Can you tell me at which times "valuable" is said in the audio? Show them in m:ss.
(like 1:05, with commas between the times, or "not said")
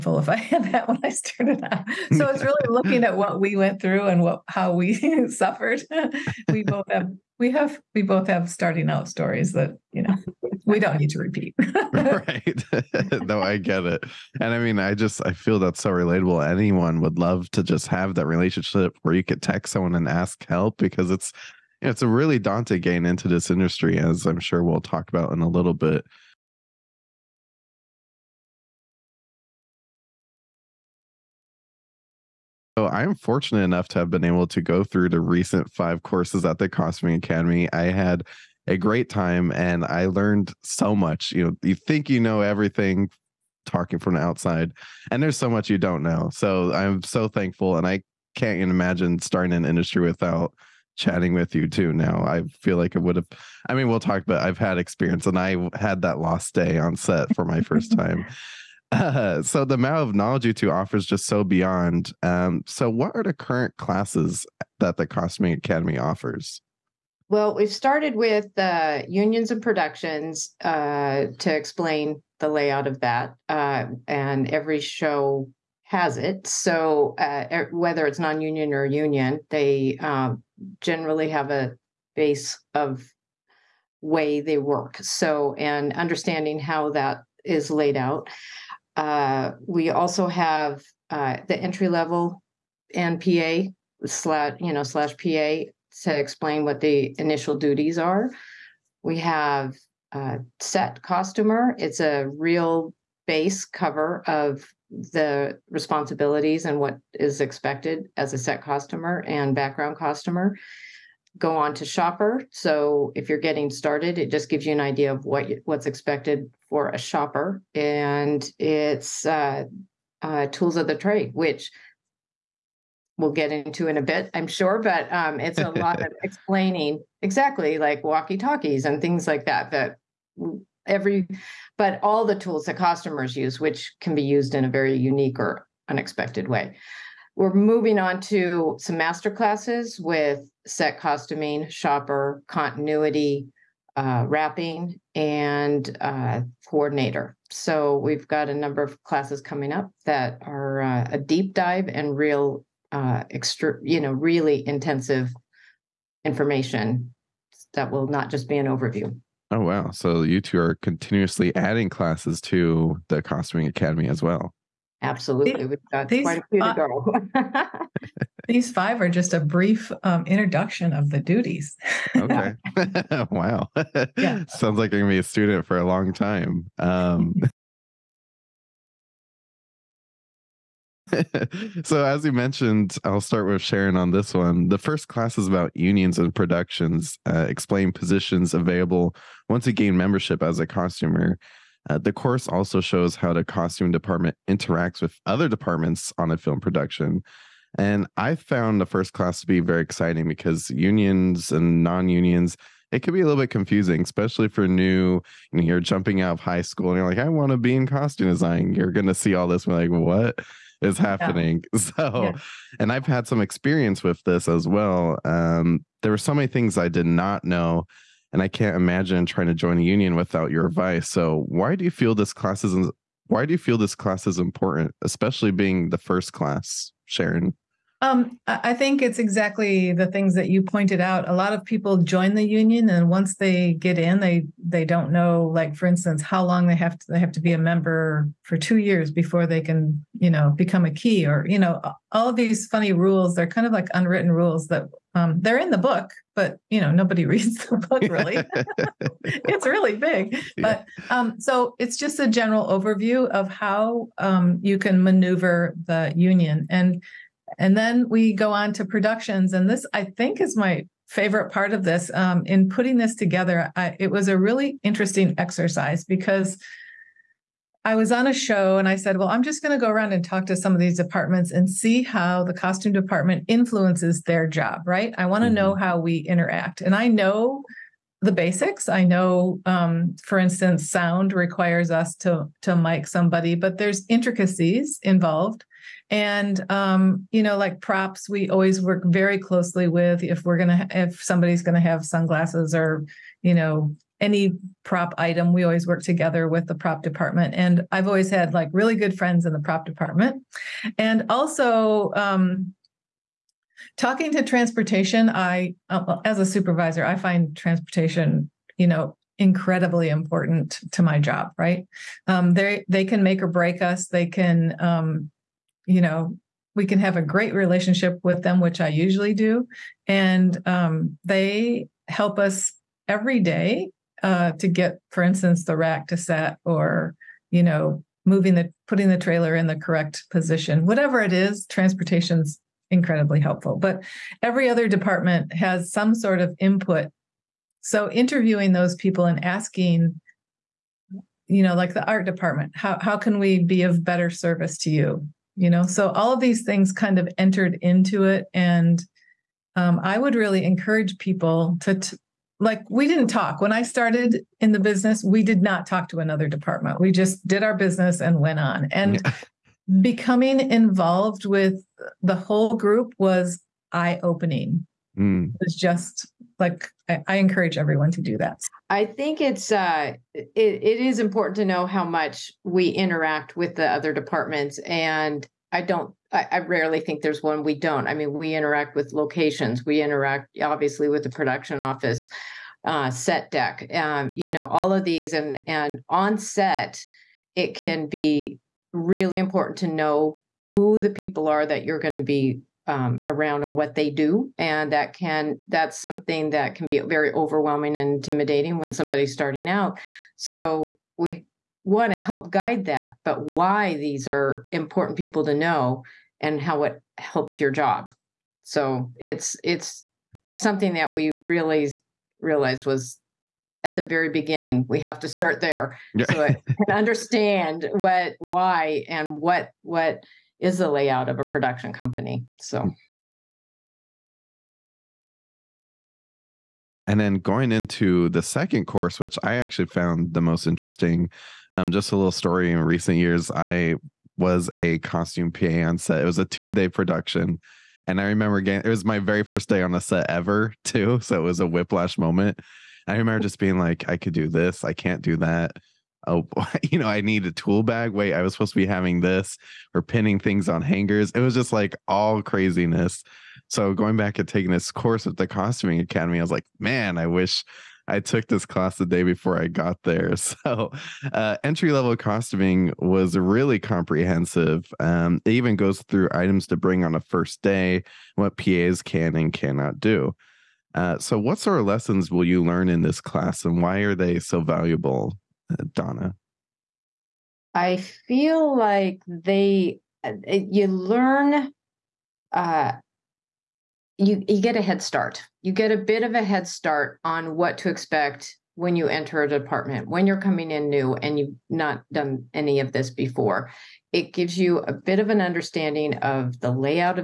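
7:54.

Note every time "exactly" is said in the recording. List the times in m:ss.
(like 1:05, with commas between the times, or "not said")
2:07, 3:49.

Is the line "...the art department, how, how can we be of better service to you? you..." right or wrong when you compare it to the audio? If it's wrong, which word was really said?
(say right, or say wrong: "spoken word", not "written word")
right.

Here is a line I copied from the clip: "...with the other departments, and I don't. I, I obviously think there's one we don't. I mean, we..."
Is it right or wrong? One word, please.
wrong.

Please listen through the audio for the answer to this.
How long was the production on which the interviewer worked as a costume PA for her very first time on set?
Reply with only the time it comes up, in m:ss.
7:16.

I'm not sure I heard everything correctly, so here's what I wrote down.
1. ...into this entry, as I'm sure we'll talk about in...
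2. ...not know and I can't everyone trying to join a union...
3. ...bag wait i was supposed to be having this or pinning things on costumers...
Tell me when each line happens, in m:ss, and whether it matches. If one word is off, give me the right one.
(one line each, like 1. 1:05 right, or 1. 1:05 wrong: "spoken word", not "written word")
1. 0:23 wrong: "industry", not "entry"
2. 3:37 wrong: "imagine", not "everyone"
3. 7:27 wrong: "hangers", not "costumers".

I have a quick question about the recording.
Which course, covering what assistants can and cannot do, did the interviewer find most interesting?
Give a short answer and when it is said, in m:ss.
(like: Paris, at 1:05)
Entry level costuming, at 7:41.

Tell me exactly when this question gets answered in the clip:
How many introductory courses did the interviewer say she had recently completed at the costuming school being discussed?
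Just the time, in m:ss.
0:35.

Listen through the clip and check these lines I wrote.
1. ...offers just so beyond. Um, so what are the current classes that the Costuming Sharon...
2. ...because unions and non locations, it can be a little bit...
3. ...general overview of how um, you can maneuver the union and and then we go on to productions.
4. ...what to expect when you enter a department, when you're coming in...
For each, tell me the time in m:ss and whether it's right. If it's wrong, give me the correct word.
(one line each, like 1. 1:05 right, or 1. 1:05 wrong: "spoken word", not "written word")
1. 1:00 wrong: "Academy", not "Sharon"
2. 3:20 wrong: "unions", not "locations"
3. 4:12 right
4. 8:07 right.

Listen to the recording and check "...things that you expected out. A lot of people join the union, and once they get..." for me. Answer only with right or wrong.
wrong.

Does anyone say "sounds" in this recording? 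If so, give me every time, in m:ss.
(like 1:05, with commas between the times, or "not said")
2:54, 4:40.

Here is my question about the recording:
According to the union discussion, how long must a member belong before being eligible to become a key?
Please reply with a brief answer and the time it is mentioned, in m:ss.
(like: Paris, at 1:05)
2 years, at 3:58.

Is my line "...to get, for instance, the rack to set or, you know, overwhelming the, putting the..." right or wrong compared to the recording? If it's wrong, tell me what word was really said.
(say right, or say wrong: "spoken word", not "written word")
wrong: "moving", not "overwhelming".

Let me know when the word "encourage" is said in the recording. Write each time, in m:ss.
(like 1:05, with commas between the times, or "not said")
5:50, 6:07.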